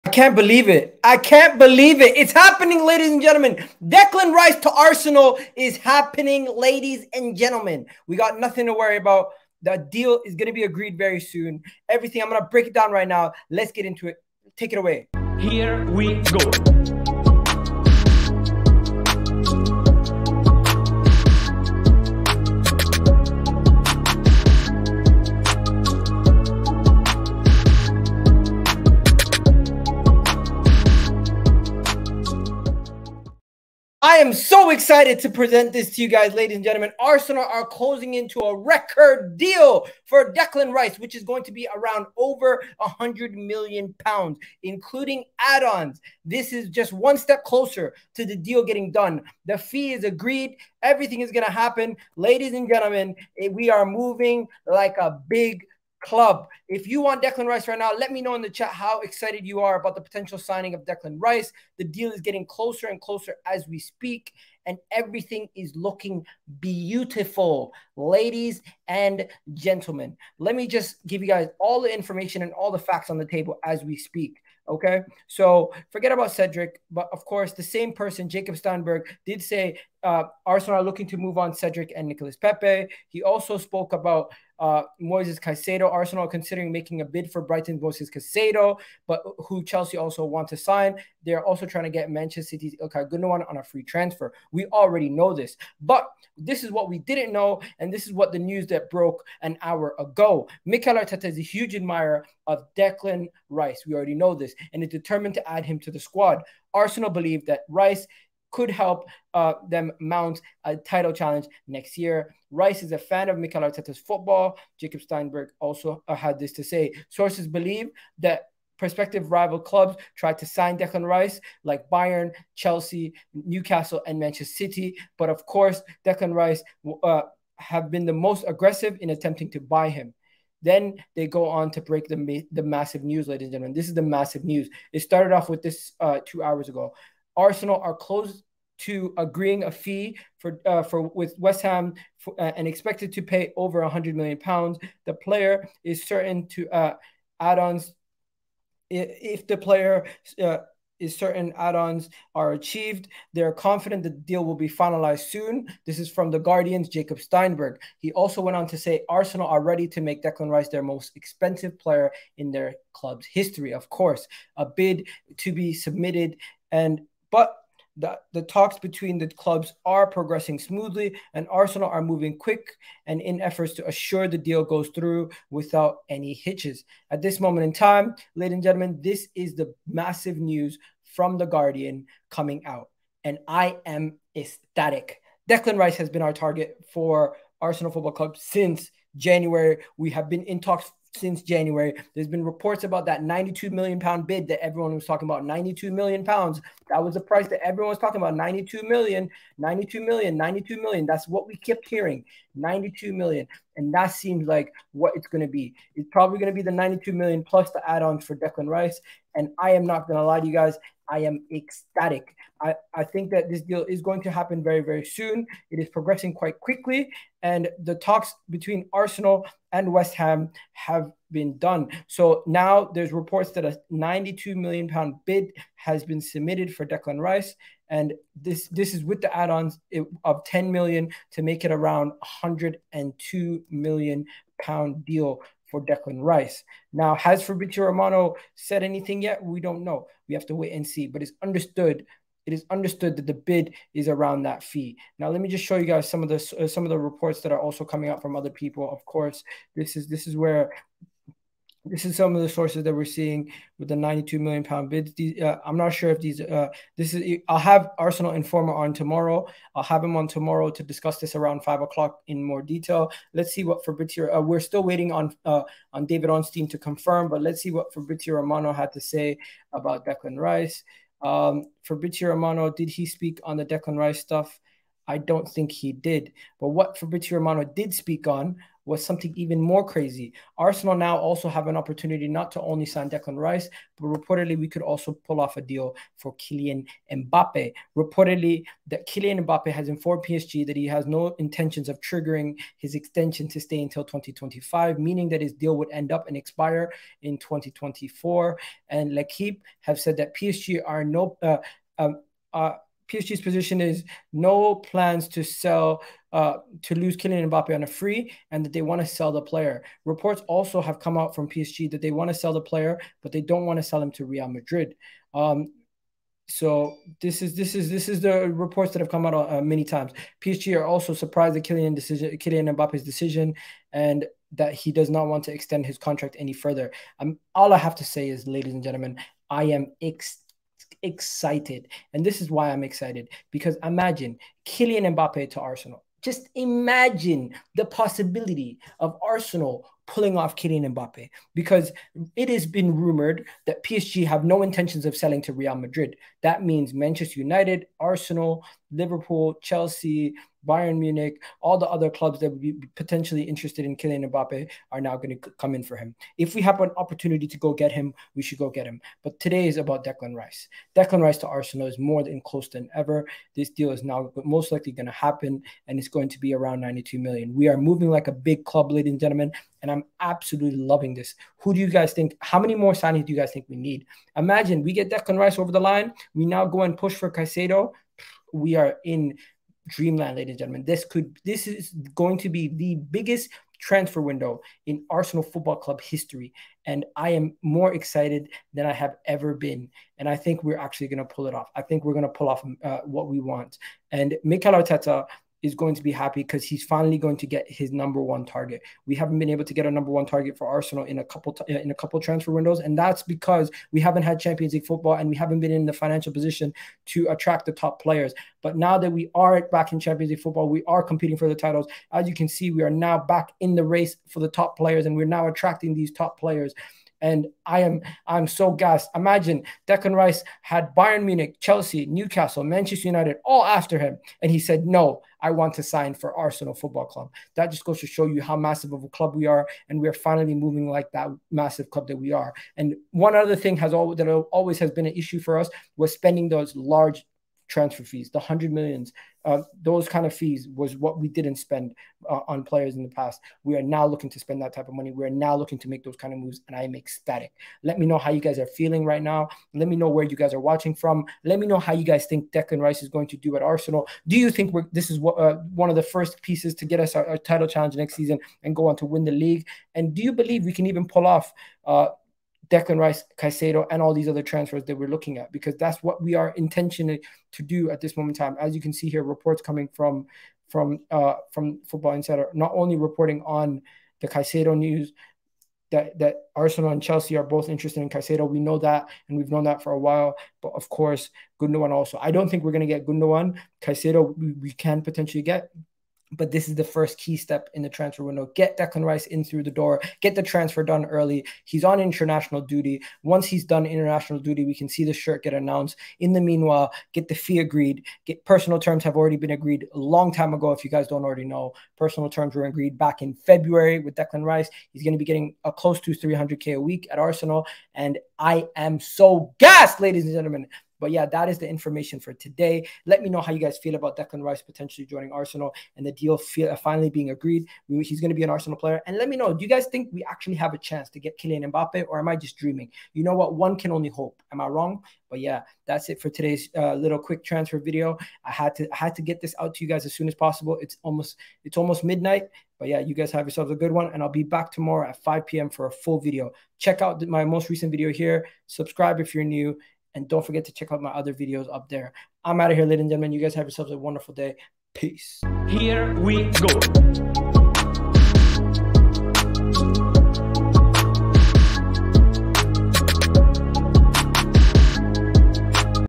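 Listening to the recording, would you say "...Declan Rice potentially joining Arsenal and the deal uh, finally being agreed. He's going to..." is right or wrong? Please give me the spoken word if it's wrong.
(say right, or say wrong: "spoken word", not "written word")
right.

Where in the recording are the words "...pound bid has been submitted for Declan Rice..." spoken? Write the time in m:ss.
3:44.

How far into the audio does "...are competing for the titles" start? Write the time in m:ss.
6:50.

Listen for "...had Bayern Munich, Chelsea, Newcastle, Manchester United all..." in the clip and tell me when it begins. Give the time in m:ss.
7:00.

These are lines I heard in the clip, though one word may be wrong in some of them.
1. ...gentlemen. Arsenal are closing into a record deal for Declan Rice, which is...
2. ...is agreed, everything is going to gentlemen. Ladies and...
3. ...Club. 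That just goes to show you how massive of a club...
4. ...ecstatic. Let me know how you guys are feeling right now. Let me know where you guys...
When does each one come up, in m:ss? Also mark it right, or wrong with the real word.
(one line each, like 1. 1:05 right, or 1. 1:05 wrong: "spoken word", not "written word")
1. 0:36 right
2. 0:49 wrong: "happen", not "gentlemen"
3. 7:07 right
4. 7:26 right.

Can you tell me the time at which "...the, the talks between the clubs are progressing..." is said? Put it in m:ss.
2:47.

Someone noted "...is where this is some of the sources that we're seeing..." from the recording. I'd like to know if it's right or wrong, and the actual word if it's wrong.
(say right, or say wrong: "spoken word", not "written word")
right.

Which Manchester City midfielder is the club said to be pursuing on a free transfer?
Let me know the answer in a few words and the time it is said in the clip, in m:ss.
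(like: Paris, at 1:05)
Ilkay Gundogan, at 1:32.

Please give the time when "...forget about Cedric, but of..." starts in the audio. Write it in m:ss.
1:15.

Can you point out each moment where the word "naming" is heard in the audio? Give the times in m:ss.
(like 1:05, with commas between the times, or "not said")
not said.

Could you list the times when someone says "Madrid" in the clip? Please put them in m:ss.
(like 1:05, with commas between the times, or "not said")
5:14, 5:45.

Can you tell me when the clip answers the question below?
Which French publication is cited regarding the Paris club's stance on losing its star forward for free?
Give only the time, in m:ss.
4:59.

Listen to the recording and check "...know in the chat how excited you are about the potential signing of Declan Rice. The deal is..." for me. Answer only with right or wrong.
right.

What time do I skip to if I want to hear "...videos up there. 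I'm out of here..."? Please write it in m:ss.
9:01.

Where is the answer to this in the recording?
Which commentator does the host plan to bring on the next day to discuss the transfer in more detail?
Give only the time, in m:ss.
4:17.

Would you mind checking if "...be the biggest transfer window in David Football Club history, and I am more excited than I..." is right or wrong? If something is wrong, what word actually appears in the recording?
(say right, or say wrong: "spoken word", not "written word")
wrong: "Arsenal", not "David".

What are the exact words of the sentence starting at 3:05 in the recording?
Declan Rice has been our target for Arsenal Football Club since January.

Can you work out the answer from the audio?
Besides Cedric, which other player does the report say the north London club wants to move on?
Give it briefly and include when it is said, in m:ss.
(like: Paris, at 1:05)
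Nicolas Pepe, at 1:22.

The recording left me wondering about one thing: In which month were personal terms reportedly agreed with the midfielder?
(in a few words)
February.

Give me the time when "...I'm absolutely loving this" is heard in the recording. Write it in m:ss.
6:09.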